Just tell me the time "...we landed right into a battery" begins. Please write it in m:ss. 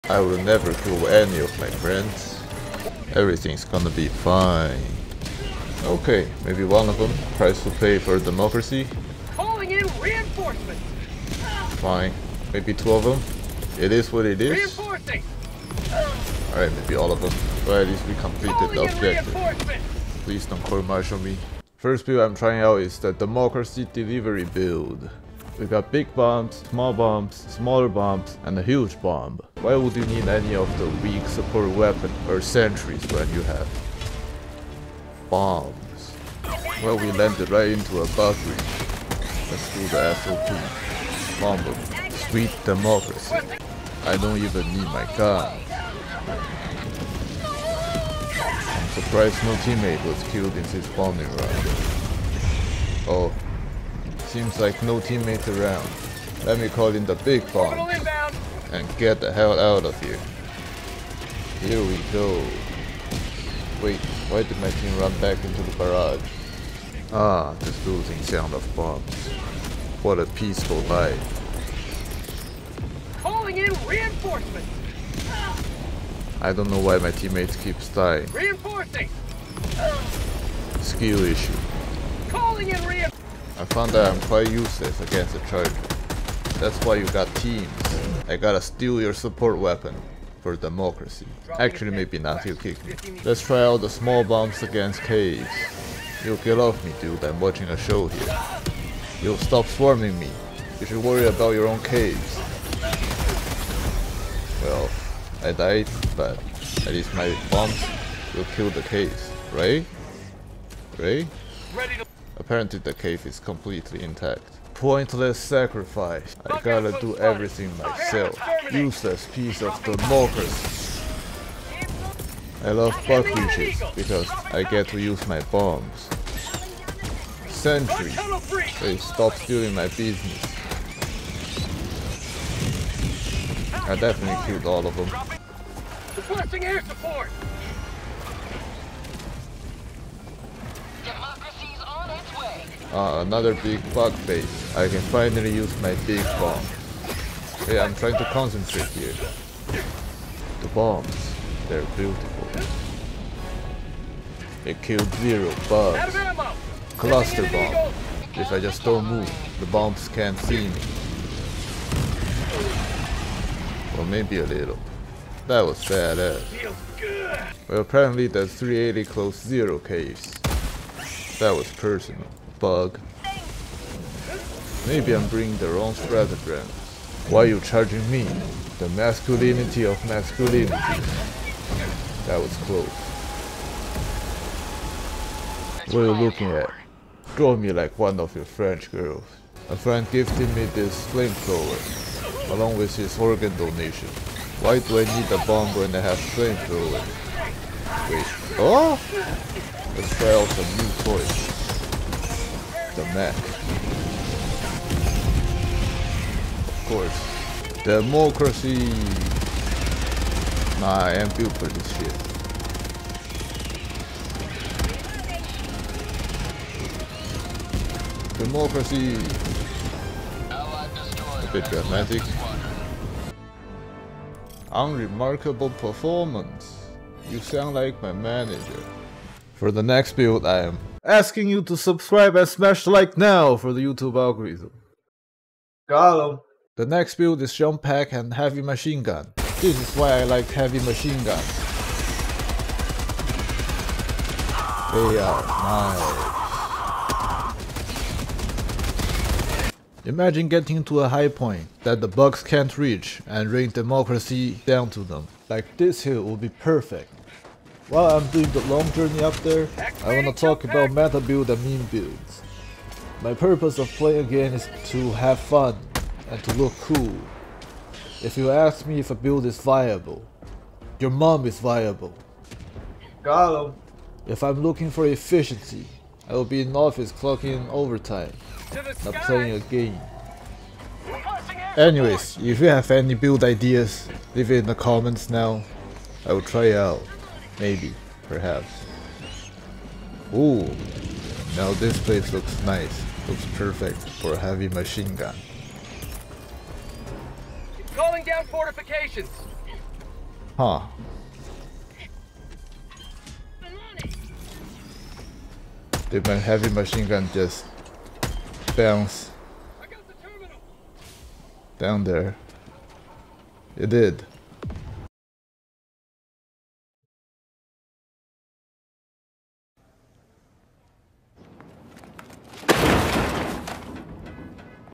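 0:36.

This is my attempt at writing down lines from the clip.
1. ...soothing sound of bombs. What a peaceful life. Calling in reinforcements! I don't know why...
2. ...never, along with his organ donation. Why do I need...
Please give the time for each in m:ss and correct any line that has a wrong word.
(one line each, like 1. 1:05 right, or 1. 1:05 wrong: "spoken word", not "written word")
1. 1:07 right
2. 3:11 wrong: "flamethrower", not "never".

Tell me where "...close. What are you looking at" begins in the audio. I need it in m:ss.
3:02.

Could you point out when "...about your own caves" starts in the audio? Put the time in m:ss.
1:41.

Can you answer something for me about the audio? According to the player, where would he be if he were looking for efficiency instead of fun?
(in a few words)
in office clocking overtime.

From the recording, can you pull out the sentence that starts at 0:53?
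Oh, Seems like no teammates around.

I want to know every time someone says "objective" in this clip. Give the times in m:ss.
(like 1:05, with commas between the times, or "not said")
0:18.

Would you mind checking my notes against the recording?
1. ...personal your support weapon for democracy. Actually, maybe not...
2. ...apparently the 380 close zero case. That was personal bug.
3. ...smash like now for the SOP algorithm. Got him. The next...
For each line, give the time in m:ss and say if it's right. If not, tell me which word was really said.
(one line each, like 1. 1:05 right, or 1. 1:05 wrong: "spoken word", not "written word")
1. 1:28 wrong: "steal", not "personal"
2. 2:47 right
3. 3:52 wrong: "YouTube", not "SOP".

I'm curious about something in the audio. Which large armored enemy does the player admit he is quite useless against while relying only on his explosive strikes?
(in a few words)
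charger.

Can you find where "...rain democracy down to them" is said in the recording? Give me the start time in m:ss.
4:13.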